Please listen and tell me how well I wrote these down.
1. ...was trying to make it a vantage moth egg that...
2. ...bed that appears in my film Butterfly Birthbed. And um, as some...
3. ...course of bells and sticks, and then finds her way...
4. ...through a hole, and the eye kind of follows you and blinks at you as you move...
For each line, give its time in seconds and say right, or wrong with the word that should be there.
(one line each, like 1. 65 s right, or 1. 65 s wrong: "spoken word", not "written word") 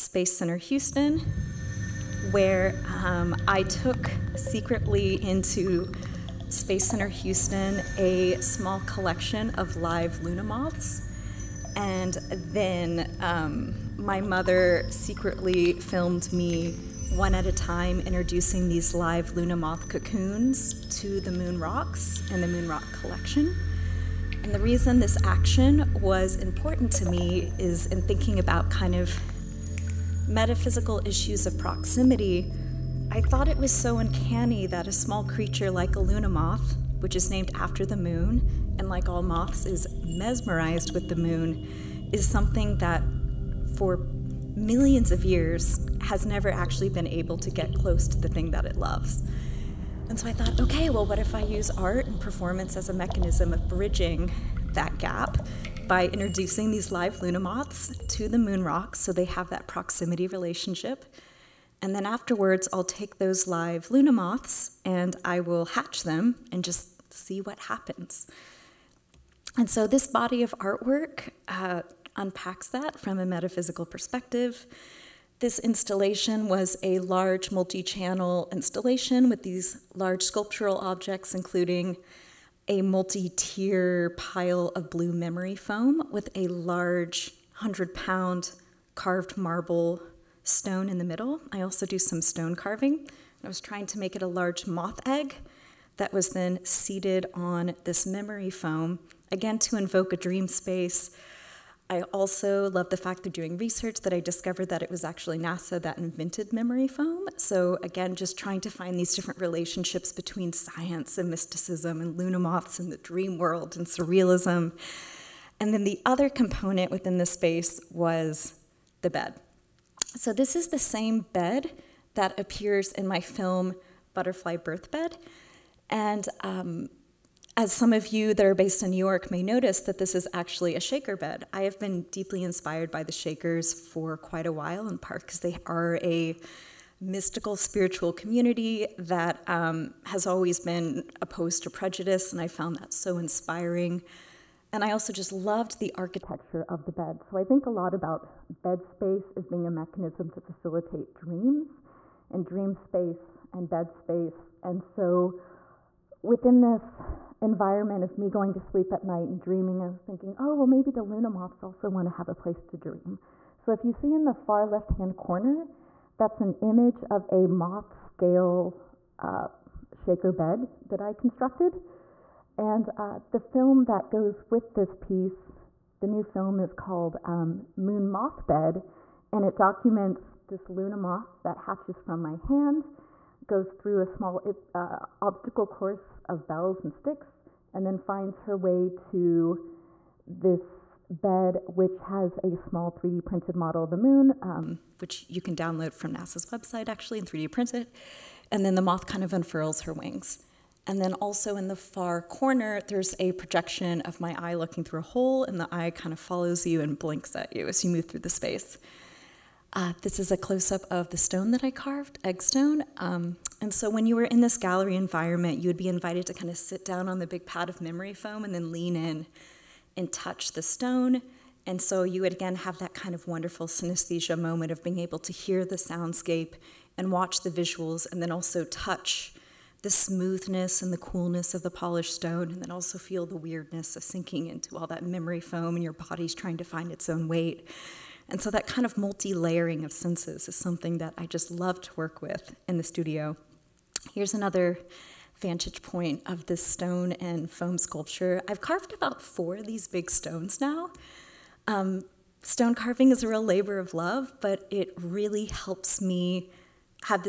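1. 93 s wrong: "large", not "vantage"
2. 121 s right
3. 185 s right
4. 204 s right.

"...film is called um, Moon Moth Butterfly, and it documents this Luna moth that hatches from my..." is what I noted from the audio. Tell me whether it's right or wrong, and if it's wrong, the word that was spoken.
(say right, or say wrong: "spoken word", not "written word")
wrong: "Bed", not "Butterfly".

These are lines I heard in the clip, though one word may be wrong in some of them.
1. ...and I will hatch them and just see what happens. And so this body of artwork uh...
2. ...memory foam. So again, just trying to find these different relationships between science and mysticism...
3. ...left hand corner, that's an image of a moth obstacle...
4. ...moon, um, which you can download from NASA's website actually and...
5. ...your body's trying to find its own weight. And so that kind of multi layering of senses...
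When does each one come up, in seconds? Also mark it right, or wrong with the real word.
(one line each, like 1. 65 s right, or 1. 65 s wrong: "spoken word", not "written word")
1. 64 s right
2. 106 s right
3. 164 s wrong: "scale", not "obstacle"
4. 193 s right
5. 235 s right.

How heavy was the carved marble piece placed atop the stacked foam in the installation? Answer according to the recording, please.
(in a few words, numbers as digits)
100 pounds.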